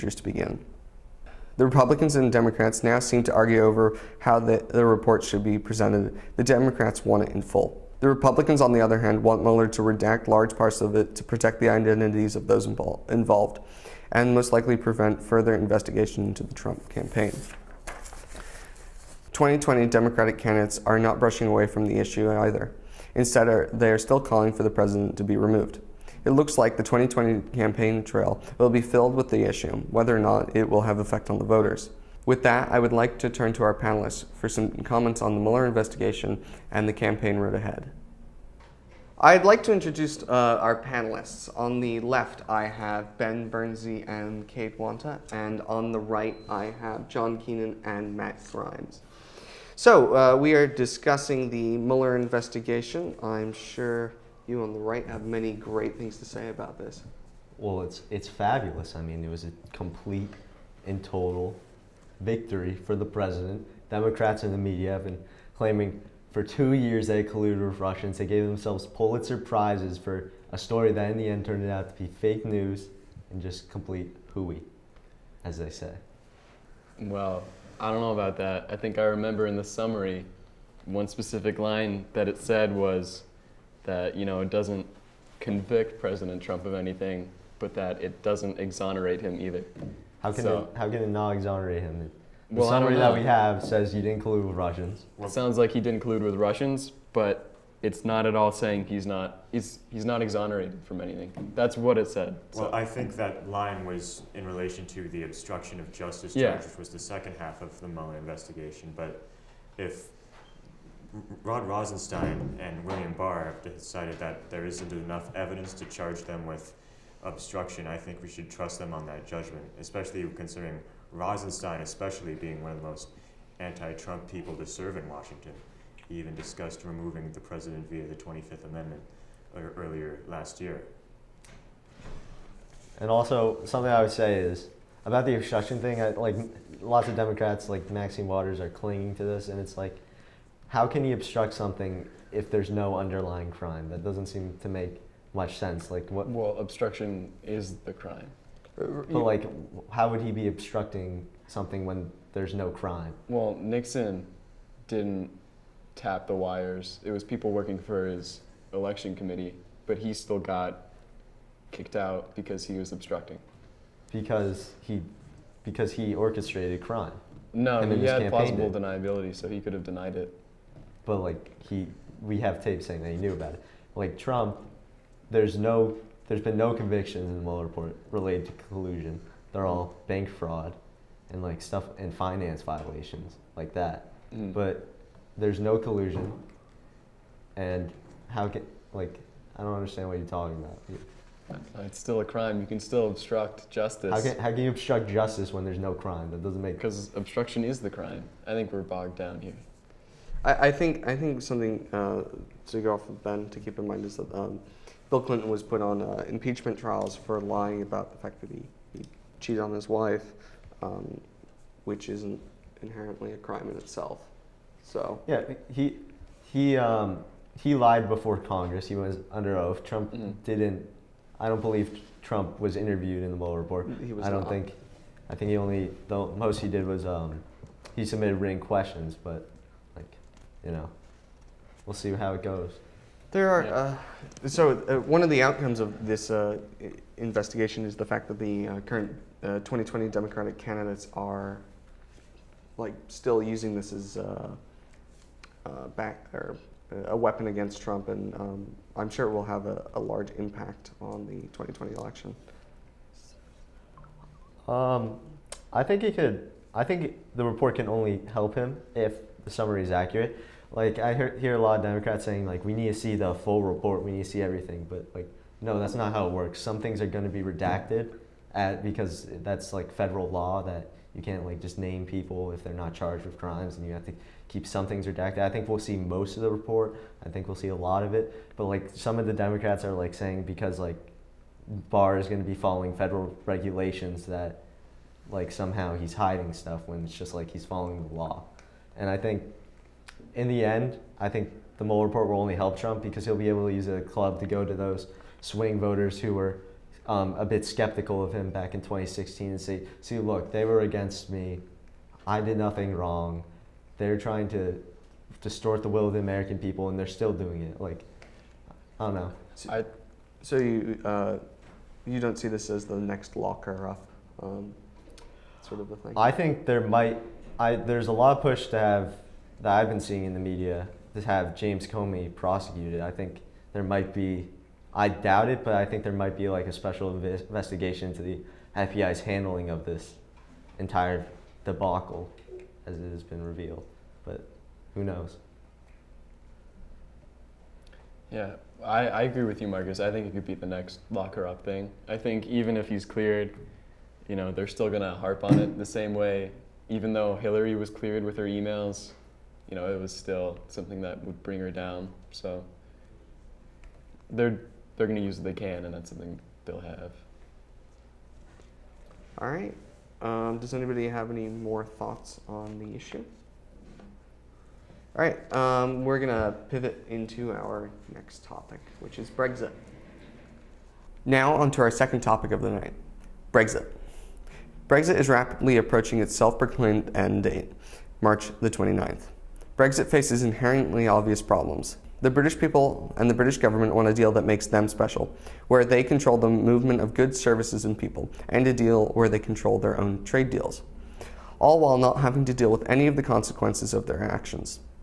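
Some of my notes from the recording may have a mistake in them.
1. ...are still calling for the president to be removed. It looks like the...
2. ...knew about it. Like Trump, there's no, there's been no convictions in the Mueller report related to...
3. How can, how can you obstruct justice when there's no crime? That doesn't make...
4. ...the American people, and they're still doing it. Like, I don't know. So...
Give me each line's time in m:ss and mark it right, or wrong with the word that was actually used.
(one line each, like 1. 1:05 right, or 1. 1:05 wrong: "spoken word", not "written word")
1. 0:23 right
2. 2:53 right
3. 3:14 right
4. 5:06 right.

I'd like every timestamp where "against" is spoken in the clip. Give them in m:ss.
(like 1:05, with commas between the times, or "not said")
4:07, 5:00.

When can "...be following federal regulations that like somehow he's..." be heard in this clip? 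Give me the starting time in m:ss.
4:42.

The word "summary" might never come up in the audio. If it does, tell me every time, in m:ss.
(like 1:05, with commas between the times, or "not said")
1:19, 1:32, 4:19.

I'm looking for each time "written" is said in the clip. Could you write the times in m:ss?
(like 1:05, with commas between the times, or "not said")
3:48.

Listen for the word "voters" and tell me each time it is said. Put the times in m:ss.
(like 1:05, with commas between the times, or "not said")
0:31, 4:55.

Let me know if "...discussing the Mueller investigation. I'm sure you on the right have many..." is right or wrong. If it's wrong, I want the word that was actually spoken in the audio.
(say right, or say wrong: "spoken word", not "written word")
right.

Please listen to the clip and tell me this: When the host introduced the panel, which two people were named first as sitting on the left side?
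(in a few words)
Ben Bernsey and Kate Wanta.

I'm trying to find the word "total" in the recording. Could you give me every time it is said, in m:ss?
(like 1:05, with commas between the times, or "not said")
1:01.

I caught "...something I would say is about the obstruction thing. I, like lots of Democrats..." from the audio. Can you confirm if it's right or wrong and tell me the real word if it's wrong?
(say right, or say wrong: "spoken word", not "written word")
right.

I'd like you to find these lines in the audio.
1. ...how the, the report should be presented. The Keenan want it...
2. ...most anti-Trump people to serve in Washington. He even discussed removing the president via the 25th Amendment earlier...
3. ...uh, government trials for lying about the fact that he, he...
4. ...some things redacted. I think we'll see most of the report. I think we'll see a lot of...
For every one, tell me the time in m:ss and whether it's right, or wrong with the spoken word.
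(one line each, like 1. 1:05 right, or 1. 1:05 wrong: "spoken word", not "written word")
1. 0:04 wrong: "Democrats", not "Keenan"
2. 2:02 right
3. 3:26 wrong: "impeachment", not "government"
4. 4:34 right.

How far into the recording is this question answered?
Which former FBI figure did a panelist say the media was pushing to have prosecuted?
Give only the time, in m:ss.
5:21.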